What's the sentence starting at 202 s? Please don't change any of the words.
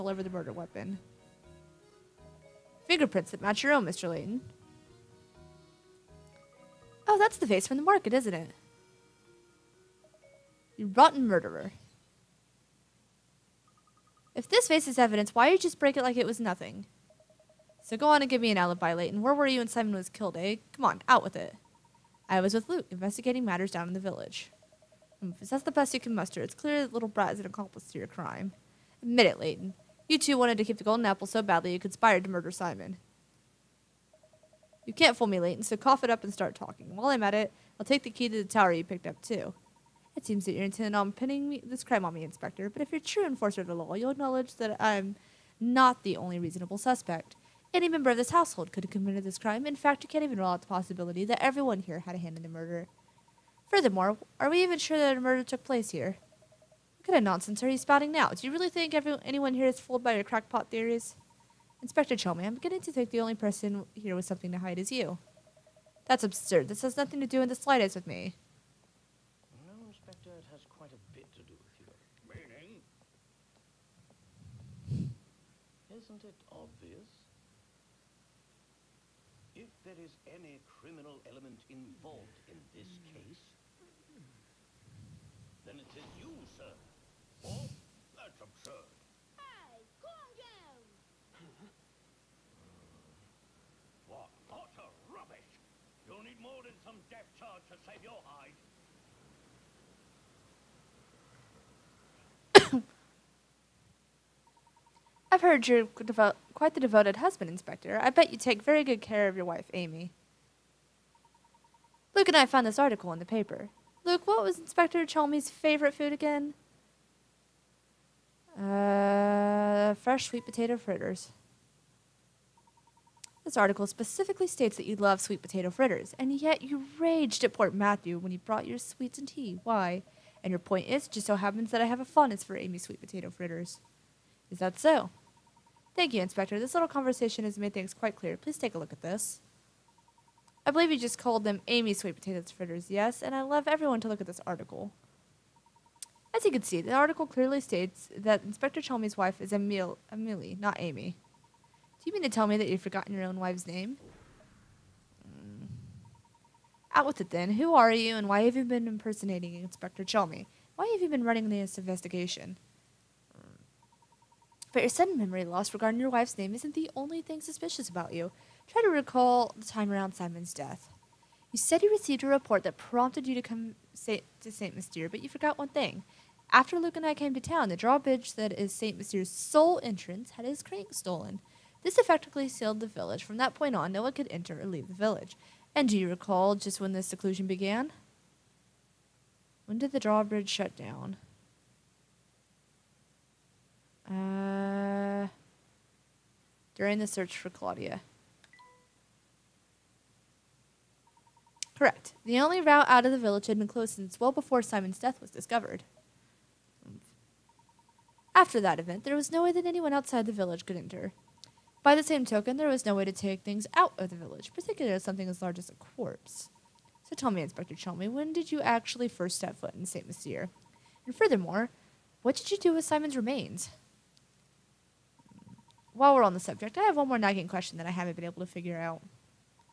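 The only route out of the village had been closed since well before Simon's death was discovered.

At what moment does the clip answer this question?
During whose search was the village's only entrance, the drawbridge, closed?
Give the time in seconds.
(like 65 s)
197 s.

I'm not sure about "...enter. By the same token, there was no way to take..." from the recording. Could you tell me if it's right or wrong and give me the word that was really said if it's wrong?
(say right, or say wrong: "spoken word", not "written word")
right.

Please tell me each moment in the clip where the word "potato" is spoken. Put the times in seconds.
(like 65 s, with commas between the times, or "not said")
120 s, 125 s, 133 s, 142 s.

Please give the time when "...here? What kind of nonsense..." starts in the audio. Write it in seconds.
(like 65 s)
55 s.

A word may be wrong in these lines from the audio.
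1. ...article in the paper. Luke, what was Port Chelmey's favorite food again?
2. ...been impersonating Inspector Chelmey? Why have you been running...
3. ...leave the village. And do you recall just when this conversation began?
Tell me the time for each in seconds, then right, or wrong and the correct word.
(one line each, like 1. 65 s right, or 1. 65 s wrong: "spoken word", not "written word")
1. 112 s wrong: "Inspector", not "Port"
2. 158 s right
3. 184 s wrong: "seclusion", not "conversation".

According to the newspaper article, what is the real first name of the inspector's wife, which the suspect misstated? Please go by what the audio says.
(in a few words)
Emily.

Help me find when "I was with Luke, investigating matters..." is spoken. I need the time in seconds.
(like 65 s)
22 s.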